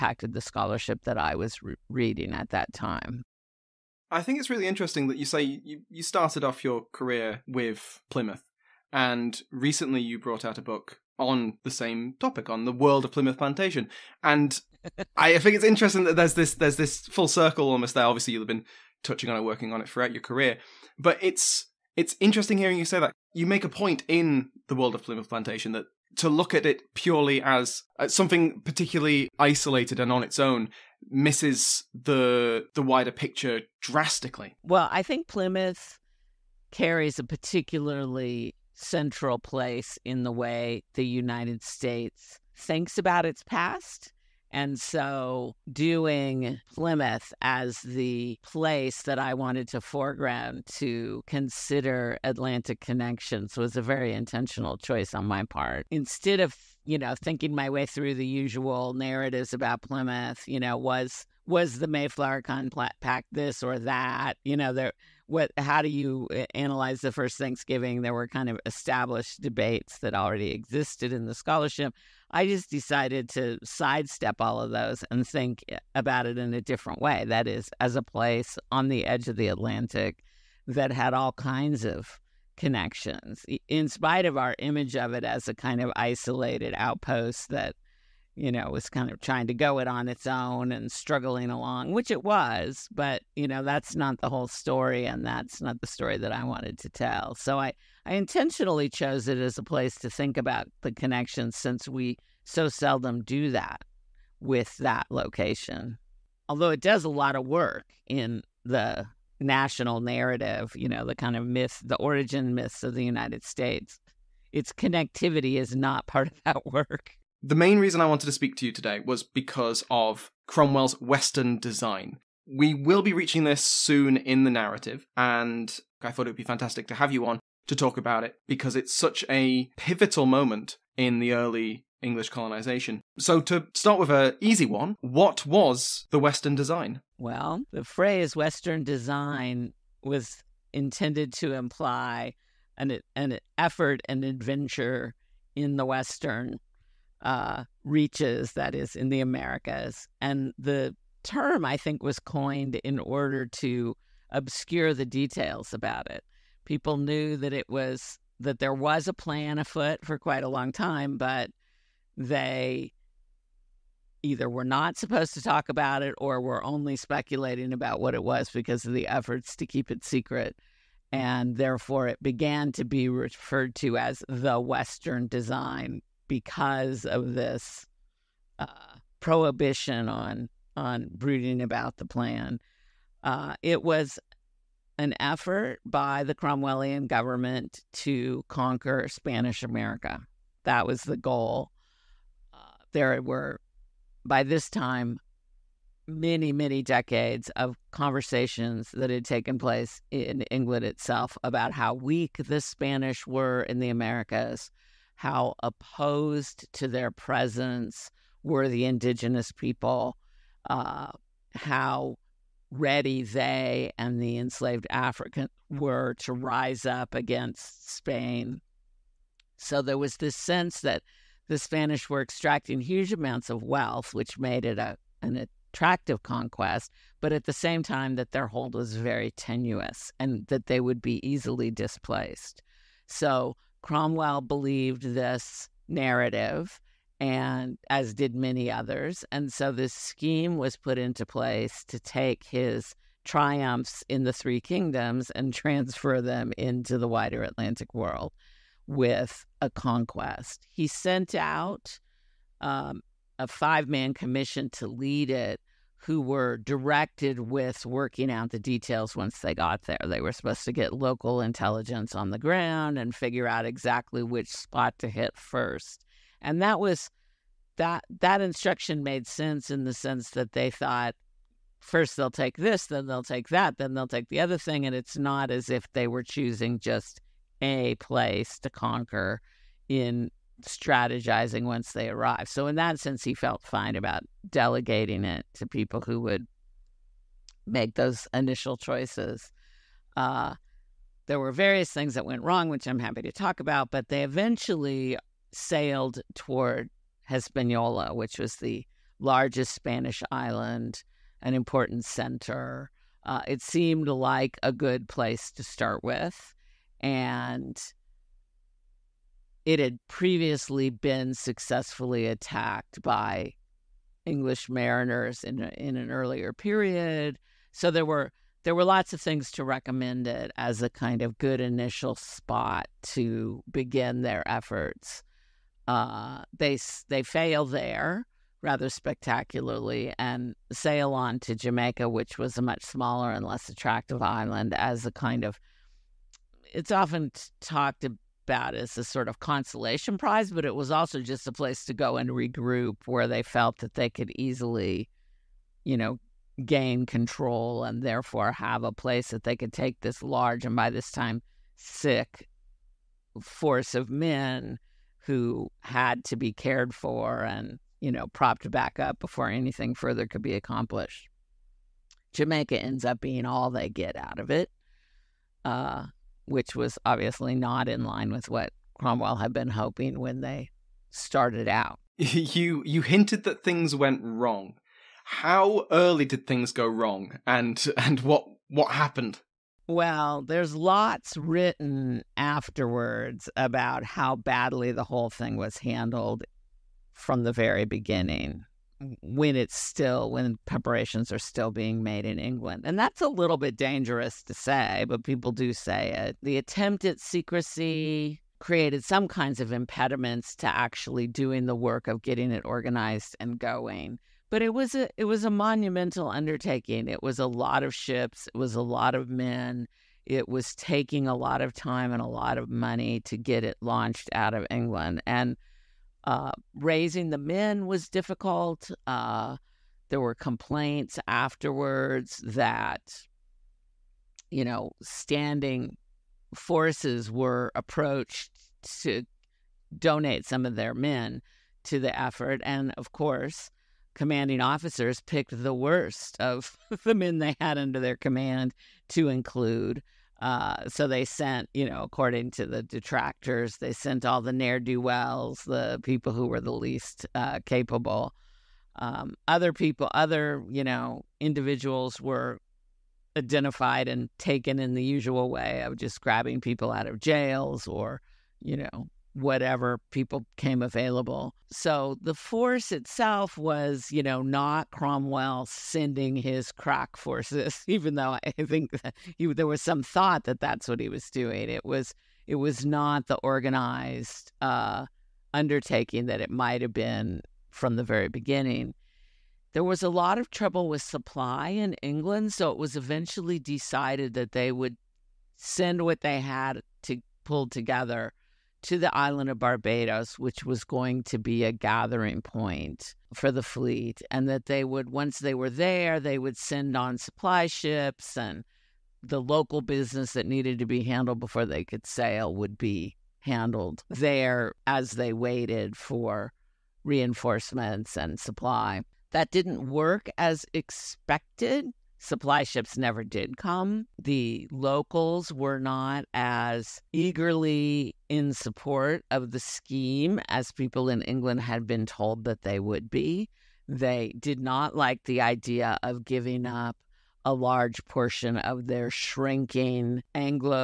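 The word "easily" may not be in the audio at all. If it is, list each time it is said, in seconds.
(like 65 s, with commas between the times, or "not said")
231 s, 344 s.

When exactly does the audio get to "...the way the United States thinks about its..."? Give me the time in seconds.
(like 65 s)
40 s.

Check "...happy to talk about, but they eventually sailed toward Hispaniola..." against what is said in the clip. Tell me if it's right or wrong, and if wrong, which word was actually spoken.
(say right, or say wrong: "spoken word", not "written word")
right.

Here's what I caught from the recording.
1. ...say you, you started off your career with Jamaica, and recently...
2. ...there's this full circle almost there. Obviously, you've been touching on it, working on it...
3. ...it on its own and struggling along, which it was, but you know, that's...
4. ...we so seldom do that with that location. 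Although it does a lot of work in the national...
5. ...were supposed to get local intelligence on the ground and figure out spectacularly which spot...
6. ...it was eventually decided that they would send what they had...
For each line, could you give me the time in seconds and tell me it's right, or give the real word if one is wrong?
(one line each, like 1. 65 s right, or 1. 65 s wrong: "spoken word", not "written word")
1. 5 s wrong: "Plymouth", not "Jamaica"
2. 16 s right
3. 89 s right
4. 101 s right
5. 260 s wrong: "exactly", not "spectacularly"
6. 482 s right.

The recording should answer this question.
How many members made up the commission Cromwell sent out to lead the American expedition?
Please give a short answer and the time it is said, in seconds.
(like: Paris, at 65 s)
5, at 253 s.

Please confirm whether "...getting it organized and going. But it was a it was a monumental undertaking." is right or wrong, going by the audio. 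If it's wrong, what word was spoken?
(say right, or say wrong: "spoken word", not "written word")
right.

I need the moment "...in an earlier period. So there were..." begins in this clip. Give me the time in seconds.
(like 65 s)
315 s.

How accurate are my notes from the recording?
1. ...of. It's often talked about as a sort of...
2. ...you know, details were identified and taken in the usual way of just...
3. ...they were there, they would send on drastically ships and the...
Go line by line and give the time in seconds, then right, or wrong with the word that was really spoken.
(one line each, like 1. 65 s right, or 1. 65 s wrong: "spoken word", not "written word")
1. 335 s right
2. 450 s wrong: "individuals", not "details"
3. 495 s wrong: "supply", not "drastically".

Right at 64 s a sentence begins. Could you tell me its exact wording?
You know, there what how do you eh, analyze the first Thanksgiving?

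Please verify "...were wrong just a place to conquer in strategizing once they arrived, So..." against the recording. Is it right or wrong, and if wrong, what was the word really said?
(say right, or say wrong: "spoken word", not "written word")
wrong: "choosing", not "wrong".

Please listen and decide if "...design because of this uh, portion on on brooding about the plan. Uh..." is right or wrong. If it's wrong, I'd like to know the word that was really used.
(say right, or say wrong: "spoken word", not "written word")
wrong: "prohibition", not "portion".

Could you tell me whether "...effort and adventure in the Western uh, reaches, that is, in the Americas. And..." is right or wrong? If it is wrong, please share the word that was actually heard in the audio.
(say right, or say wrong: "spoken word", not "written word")
right.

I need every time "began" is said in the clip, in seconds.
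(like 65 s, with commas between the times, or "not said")
172 s.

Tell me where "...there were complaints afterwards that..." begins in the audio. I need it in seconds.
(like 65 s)
420 s.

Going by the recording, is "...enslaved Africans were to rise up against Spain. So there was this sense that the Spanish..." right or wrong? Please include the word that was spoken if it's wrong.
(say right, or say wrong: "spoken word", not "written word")
right.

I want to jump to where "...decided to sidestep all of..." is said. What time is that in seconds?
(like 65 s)
72 s.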